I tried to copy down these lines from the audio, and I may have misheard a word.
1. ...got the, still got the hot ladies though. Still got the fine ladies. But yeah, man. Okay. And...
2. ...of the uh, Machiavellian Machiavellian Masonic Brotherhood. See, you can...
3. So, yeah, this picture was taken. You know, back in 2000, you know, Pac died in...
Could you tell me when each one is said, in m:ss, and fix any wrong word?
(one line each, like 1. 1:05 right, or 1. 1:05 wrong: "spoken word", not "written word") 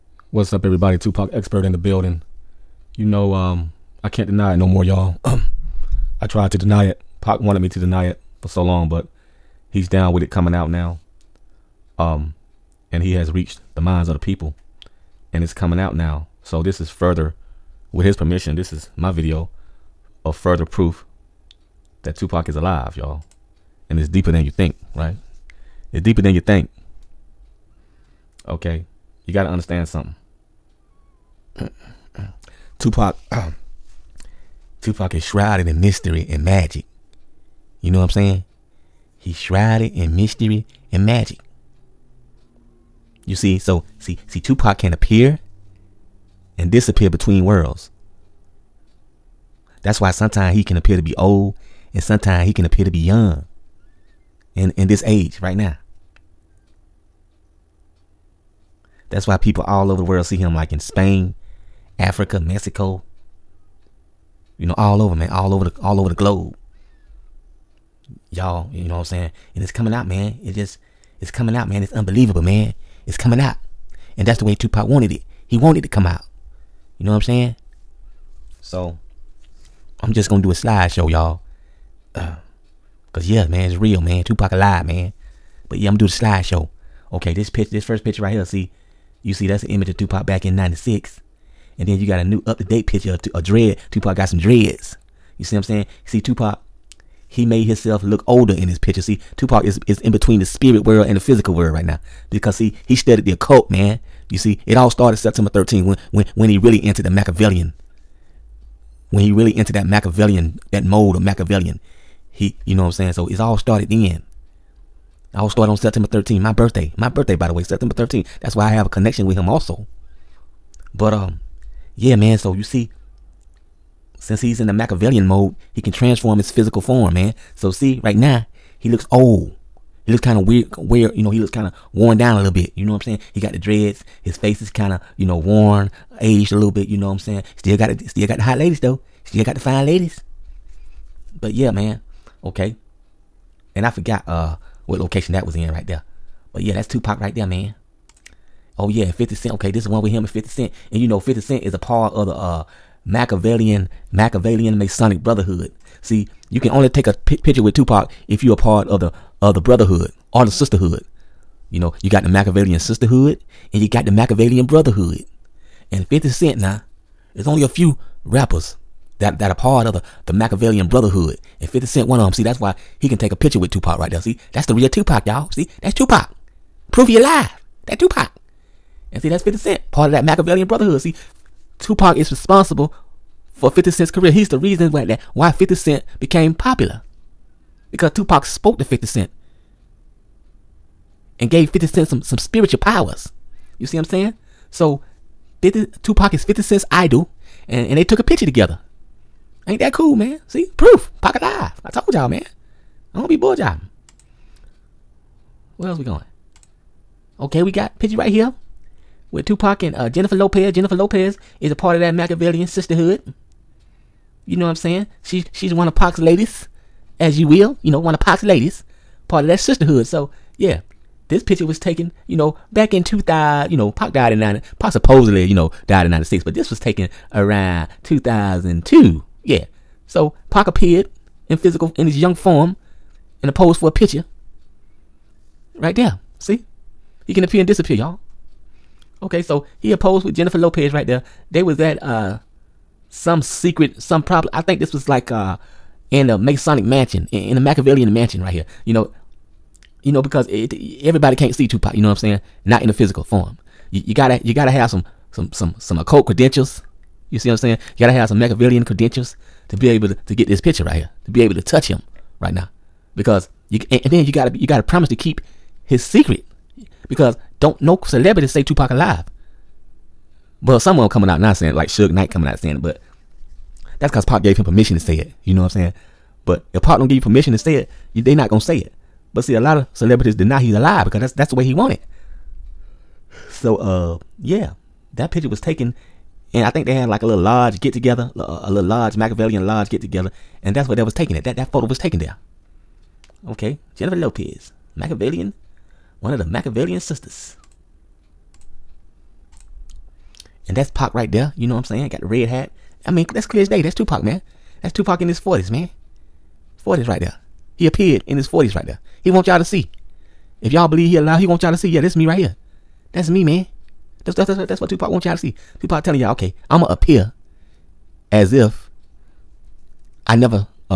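1. 2:17 right
2. 2:32 right
3. 3:40 right.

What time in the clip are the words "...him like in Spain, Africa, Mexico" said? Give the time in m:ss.
1:00.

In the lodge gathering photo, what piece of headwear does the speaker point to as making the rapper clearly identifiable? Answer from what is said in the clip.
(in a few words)
Red hat.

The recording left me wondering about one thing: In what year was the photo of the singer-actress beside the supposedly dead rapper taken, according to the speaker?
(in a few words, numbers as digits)
2002.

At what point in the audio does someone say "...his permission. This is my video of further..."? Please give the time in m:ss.
0:18.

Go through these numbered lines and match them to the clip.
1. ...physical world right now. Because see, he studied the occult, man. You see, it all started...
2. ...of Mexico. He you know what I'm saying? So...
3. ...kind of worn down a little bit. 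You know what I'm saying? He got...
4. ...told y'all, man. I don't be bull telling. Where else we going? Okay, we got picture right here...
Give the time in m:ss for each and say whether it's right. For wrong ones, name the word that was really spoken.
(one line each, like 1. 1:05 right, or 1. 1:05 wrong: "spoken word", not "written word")
1. 1:41 right
2. 1:51 wrong: "Machiavellian", not "Mexico"
3. 2:11 right
4. 3:21 wrong: "jiving", not "telling".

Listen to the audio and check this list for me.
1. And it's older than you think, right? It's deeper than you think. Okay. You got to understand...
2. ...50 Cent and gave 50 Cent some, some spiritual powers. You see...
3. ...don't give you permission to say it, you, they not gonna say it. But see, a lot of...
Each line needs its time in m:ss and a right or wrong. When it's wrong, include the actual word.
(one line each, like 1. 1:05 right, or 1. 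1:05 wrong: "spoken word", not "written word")
1. 0:23 wrong: "deeper", not "older"
2. 3:08 right
3. 4:36 right.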